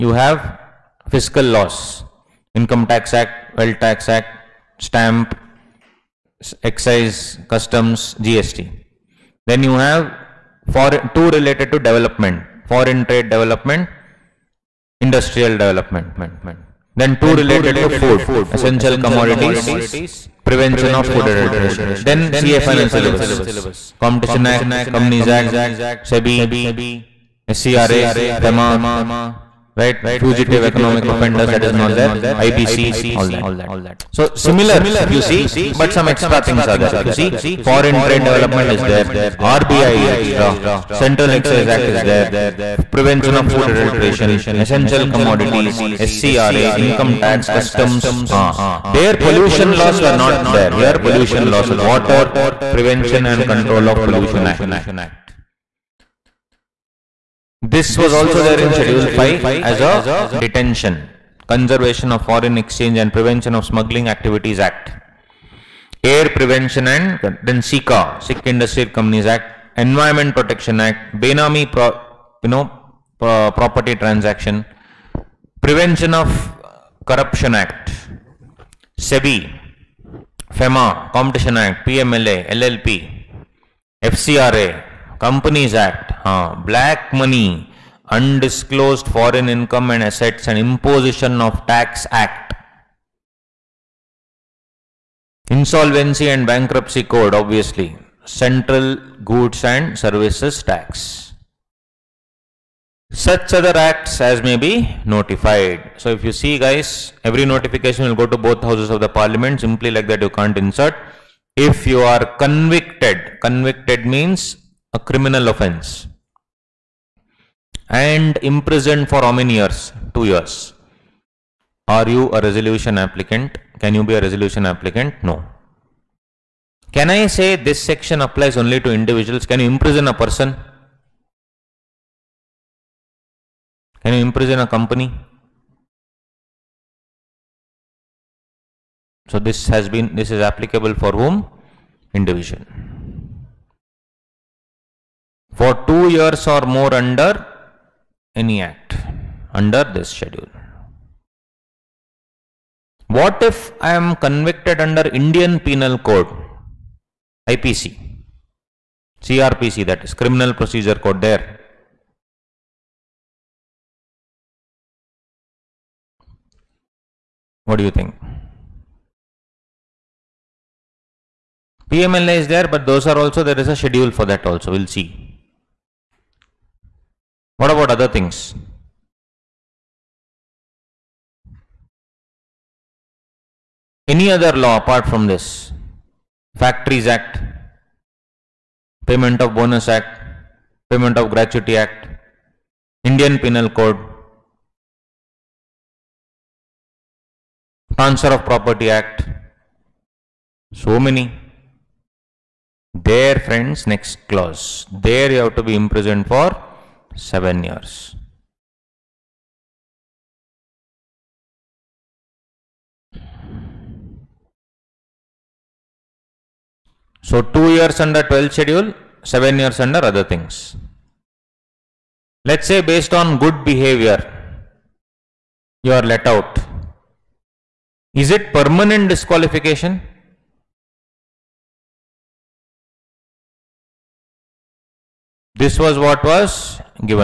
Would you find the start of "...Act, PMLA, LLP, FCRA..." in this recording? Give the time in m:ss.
1:21.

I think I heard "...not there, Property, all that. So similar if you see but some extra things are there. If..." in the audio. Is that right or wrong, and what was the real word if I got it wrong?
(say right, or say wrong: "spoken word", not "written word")
wrong: "IBC", not "Property".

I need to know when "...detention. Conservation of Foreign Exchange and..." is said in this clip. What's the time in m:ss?
1:00.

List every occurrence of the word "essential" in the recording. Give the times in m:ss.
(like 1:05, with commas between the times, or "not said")
0:18, 0:44.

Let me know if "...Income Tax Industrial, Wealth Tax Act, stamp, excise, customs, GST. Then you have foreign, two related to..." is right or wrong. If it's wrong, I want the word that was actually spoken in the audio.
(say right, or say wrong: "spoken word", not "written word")
wrong: "Act", not "Industrial".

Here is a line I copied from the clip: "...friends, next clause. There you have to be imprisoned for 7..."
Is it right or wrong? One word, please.
right.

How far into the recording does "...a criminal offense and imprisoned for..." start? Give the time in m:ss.
1:54.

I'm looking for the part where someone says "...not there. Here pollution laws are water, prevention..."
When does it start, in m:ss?
0:50.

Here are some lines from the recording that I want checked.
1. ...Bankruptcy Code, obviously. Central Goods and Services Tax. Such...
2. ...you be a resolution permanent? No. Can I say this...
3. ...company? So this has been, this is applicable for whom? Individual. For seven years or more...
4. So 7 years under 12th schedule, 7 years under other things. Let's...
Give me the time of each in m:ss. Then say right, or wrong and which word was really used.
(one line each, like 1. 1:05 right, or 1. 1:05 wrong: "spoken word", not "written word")
1. 1:36 right
2. 2:03 wrong: "applicant", not "permanent"
3. 2:14 wrong: "two", not "seven"
4. 3:37 wrong: "2", not "7".